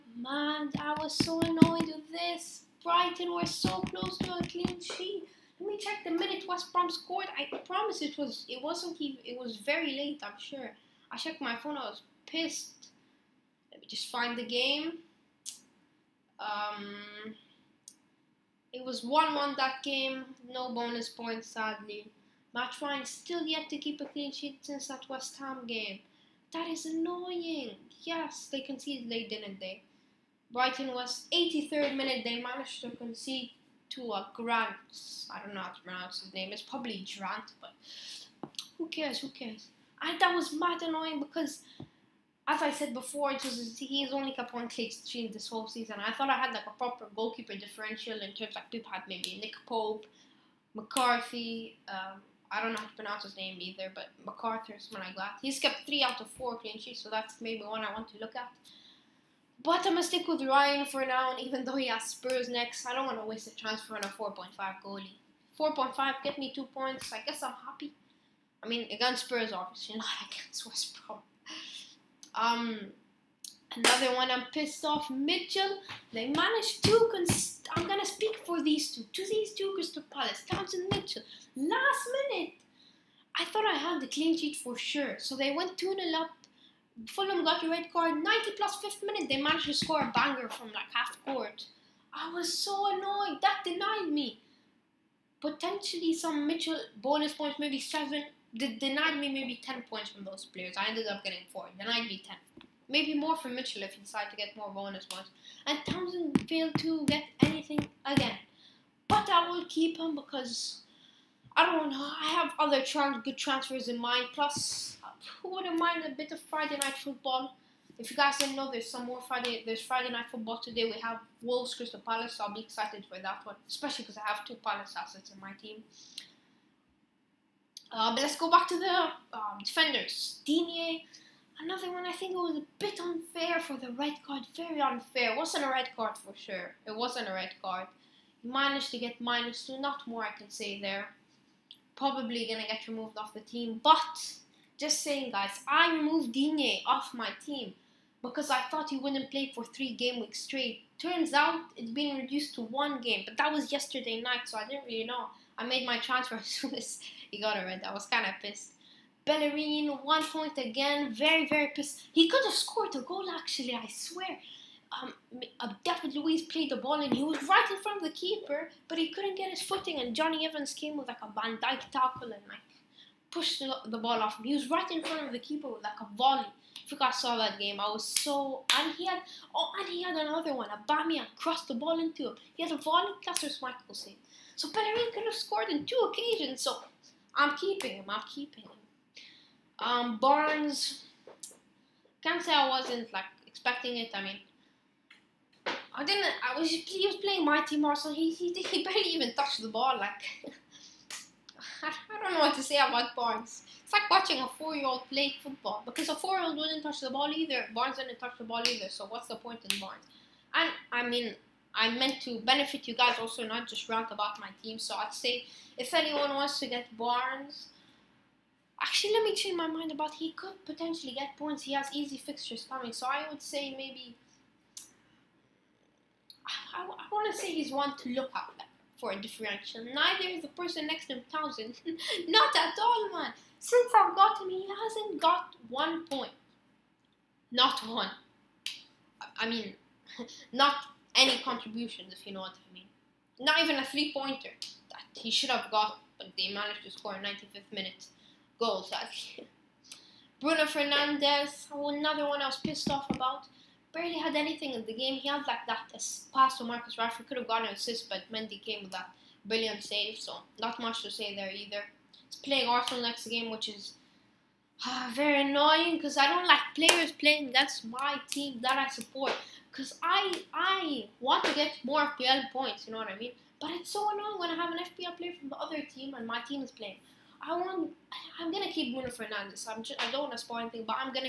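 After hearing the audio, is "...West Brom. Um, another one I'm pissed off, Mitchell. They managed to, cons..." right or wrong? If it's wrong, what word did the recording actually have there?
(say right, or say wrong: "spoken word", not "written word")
right.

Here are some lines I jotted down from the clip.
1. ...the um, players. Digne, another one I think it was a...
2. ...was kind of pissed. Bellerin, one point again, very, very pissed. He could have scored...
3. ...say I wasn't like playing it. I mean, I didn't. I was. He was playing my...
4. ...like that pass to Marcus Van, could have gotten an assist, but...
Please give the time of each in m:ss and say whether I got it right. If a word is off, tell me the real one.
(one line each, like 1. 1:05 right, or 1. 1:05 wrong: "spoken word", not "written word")
1. 2:08 wrong: "defenders", not "players"
2. 2:37 right
3. 3:12 wrong: "expecting", not "playing"
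4. 4:15 wrong: "Rashford", not "Van".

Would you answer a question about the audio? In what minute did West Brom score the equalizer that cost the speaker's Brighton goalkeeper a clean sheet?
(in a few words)
83rd minute.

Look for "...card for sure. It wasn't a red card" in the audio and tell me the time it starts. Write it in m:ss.
2:15.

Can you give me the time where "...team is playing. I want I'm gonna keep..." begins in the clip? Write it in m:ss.
4:36.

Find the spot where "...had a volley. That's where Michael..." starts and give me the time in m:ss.
3:02.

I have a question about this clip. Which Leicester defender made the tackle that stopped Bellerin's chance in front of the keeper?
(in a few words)
Jonny Evans.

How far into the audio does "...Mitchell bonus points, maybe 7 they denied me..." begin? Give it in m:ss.
1:36.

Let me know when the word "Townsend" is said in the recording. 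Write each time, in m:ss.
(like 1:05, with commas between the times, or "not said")
1:20, 1:45, 3:51.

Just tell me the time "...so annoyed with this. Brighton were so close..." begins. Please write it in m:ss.
0:01.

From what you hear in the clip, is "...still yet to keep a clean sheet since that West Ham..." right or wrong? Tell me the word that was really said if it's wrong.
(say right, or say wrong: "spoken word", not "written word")
right.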